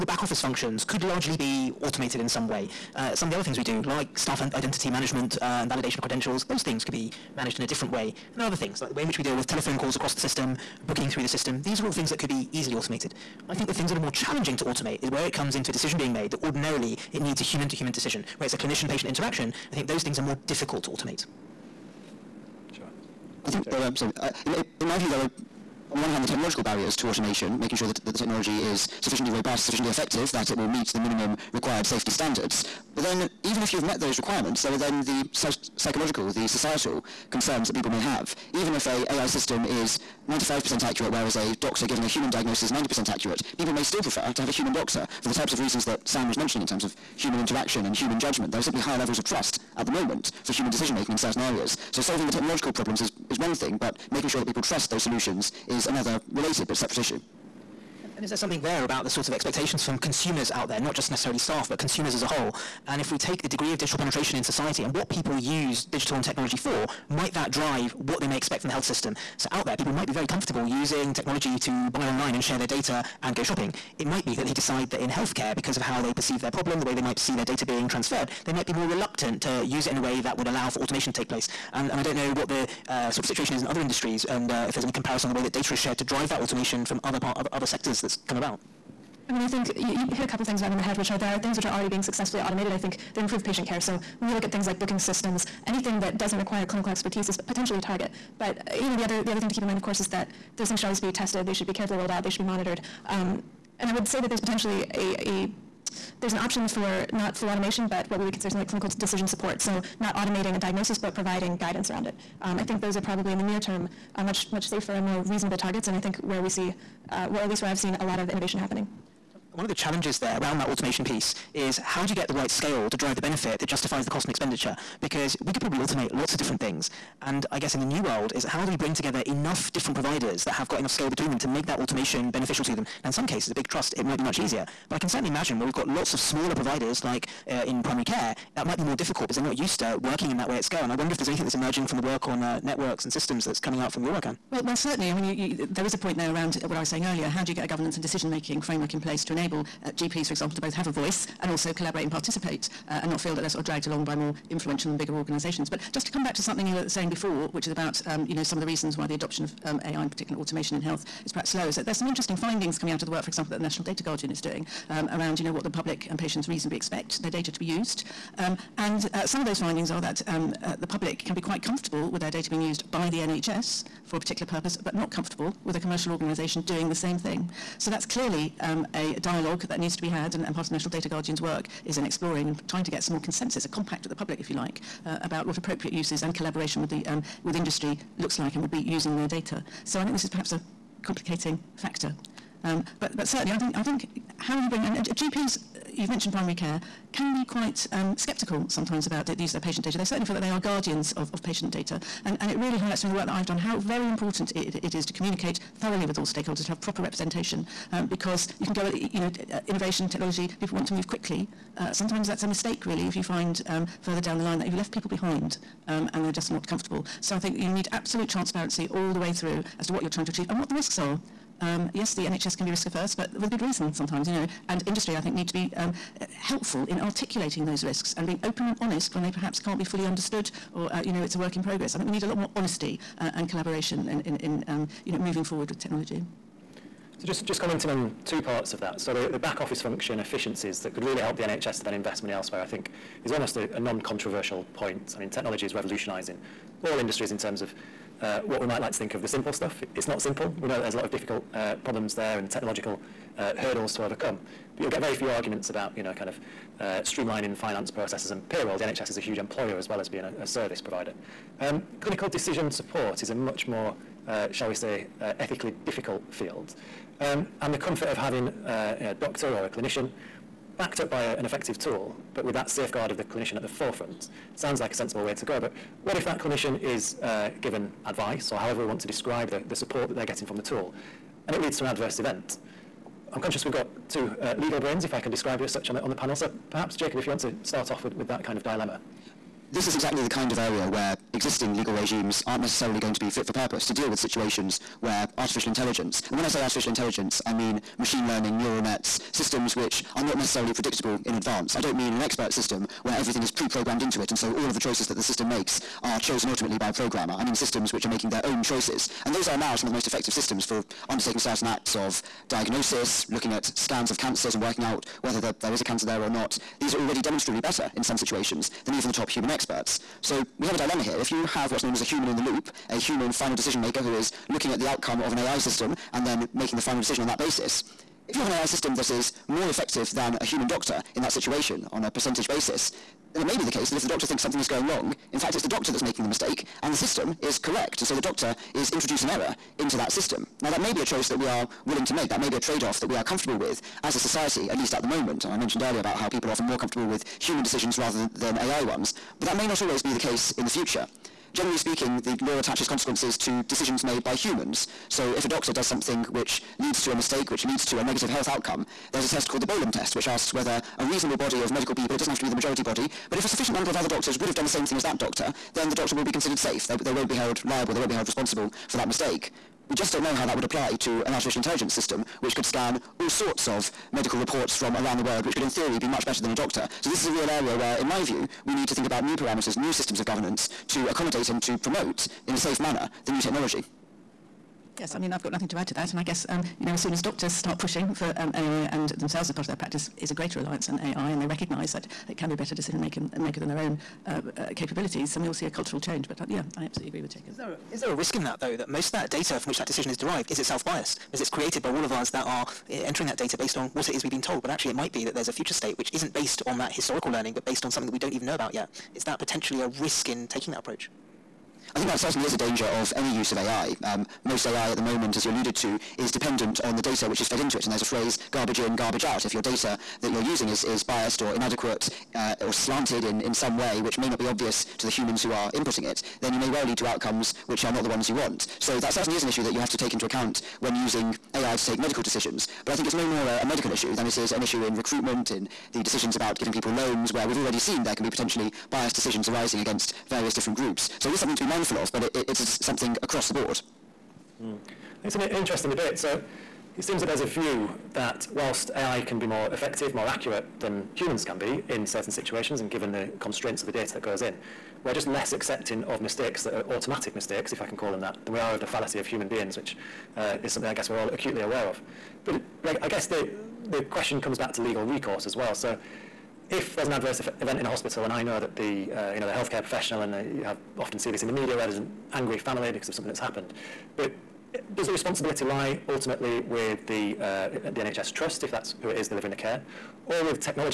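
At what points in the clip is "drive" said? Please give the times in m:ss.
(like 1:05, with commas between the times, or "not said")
1:07, 1:26, 2:02.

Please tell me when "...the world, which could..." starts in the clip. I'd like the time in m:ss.
6:15.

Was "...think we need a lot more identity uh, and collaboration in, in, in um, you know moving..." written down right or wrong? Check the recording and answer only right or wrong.
wrong.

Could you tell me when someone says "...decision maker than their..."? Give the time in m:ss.
6:32.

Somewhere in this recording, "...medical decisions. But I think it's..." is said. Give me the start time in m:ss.
7:11.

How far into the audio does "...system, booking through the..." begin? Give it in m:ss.
0:10.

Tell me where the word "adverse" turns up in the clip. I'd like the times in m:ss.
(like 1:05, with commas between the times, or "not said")
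4:41, 7:47.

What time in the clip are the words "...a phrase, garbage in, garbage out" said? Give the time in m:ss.
6:57.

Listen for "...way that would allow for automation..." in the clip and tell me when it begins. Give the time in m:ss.
1:19.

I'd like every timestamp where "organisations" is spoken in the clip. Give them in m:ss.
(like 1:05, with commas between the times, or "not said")
2:35, 2:56.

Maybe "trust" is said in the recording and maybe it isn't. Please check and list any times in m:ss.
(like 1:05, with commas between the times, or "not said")
0:49, 0:54, 2:13, 7:58.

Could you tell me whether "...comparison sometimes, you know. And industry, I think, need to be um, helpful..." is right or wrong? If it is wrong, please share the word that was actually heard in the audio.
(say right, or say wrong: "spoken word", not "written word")
wrong: "reason", not "comparison".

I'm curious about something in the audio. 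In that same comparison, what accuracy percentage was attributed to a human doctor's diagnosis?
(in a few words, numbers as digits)
90%.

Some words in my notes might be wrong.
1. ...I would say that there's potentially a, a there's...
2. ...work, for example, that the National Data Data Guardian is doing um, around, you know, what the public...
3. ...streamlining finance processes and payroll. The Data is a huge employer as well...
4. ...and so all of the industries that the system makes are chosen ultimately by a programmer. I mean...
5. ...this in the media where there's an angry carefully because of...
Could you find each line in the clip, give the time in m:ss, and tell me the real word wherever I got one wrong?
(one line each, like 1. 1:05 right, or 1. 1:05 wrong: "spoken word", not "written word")
1. 1:43 right
2. 2:43 right
3. 4:17 wrong: "NHS", not "Data"
4. 5:04 wrong: "choices", not "industries"
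5. 7:51 wrong: "family", not "carefully".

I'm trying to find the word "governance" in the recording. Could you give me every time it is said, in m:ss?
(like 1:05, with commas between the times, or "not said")
2:27, 6:20.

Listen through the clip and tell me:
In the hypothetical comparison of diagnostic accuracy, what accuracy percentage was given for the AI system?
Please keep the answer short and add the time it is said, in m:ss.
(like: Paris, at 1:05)
95%, at 0:40.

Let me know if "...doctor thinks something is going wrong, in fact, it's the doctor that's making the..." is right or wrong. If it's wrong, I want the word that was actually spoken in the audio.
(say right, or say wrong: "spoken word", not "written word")
right.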